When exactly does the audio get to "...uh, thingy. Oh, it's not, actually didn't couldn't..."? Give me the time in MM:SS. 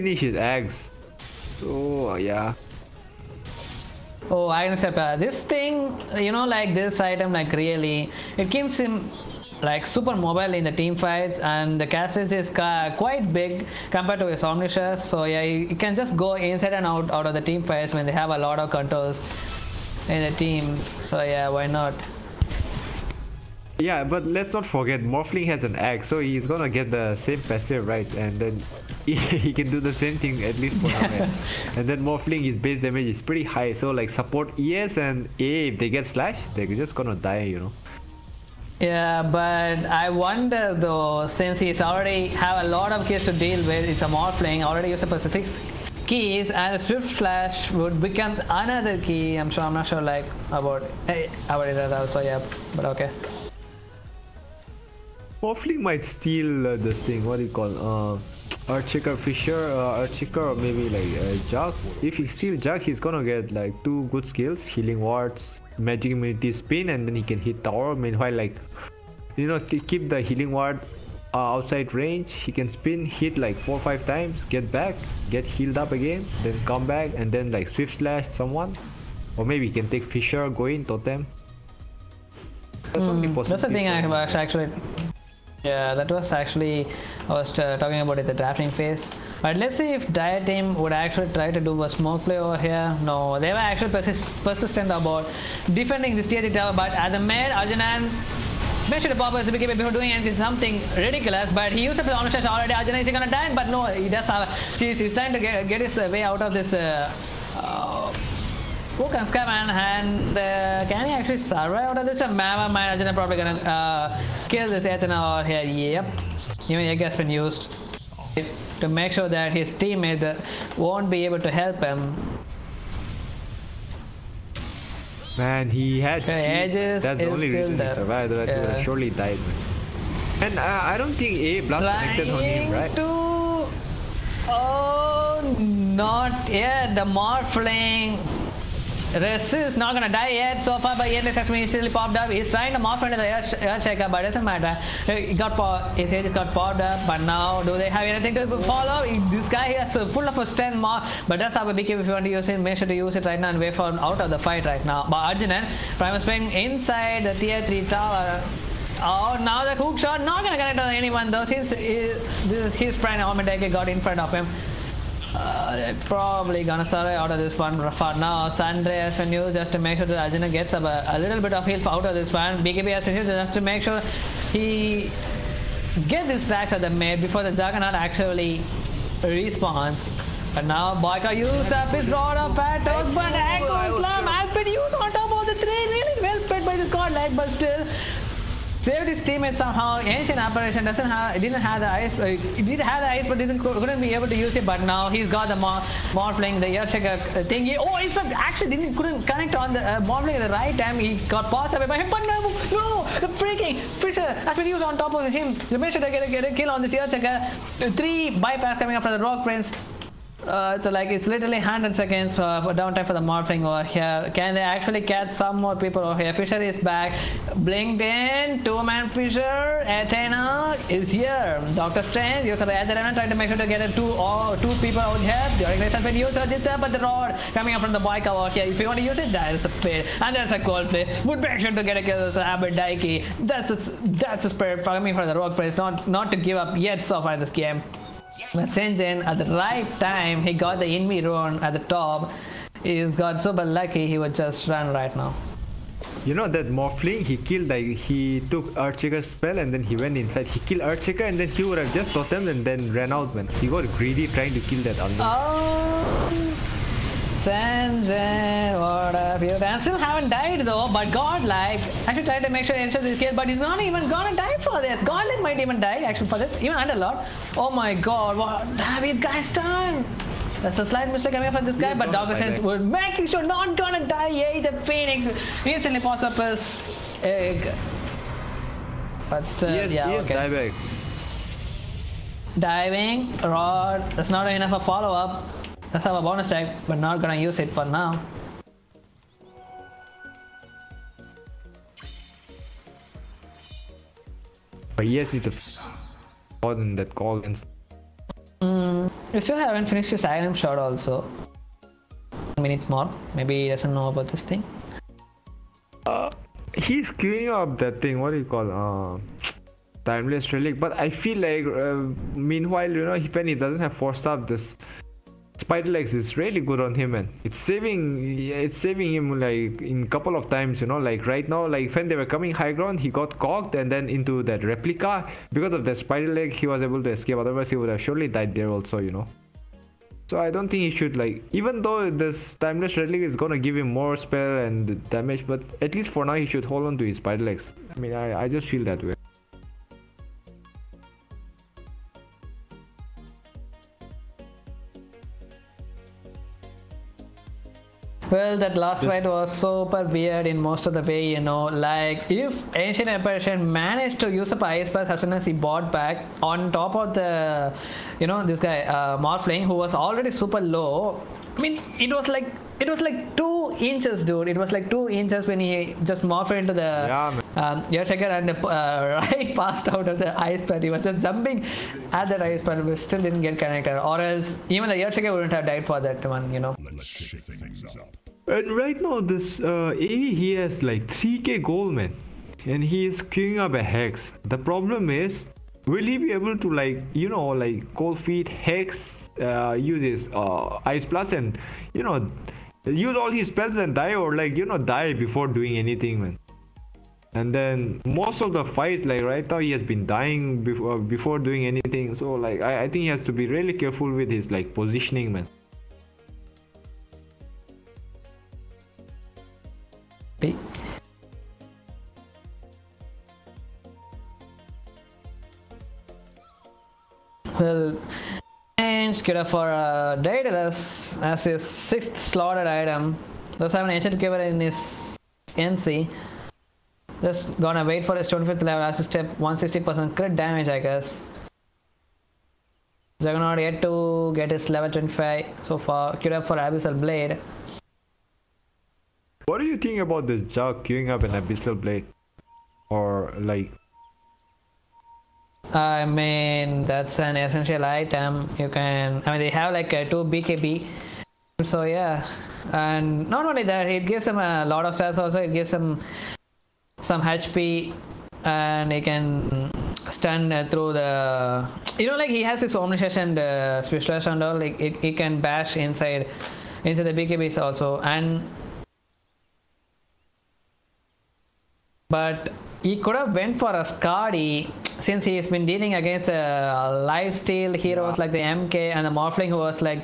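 03:17.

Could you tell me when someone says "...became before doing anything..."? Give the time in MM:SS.
01:39.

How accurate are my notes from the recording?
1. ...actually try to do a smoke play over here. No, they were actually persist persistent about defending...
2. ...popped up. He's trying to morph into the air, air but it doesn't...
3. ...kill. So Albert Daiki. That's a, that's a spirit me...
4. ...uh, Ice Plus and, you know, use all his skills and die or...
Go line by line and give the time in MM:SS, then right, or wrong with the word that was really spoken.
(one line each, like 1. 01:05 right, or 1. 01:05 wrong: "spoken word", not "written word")
1. 01:30 right
2. 02:21 right
3. 03:52 right
4. 06:30 wrong: "spells", not "skills".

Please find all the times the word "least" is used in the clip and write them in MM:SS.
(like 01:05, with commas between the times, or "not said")
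00:30, 05:35.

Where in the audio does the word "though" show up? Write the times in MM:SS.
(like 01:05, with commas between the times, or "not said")
00:40, 02:41, 04:20, 05:31.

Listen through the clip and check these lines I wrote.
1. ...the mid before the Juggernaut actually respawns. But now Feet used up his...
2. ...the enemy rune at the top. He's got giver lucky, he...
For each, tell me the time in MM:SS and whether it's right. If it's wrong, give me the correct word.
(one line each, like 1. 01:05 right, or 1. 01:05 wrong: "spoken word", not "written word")
1. 02:56 wrong: "Boyka", not "Feet"
2. 04:00 wrong: "super", not "giver".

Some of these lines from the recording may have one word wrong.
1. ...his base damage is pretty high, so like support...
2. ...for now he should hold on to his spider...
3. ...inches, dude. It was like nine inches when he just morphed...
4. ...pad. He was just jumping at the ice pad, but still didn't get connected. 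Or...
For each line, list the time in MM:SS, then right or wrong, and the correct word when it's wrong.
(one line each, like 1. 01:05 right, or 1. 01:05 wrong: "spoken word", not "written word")
1. 00:32 right
2. 05:36 right
3. 06:03 wrong: "two", not "nine"
4. 06:10 right.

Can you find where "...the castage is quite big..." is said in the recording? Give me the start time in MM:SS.
00:11.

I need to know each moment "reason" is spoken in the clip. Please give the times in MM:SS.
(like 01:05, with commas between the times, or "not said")
02:07.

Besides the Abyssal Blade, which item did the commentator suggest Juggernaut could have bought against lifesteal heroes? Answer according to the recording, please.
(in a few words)
Skadi.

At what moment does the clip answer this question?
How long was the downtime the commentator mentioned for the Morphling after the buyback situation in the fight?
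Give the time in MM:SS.
03:31.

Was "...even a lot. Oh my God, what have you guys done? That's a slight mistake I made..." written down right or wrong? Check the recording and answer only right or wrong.
right.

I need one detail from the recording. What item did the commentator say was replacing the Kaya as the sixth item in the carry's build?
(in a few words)
Daedalus.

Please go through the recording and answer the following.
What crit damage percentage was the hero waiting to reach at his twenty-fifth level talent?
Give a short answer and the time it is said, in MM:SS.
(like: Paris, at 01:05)
160%, at 07:09.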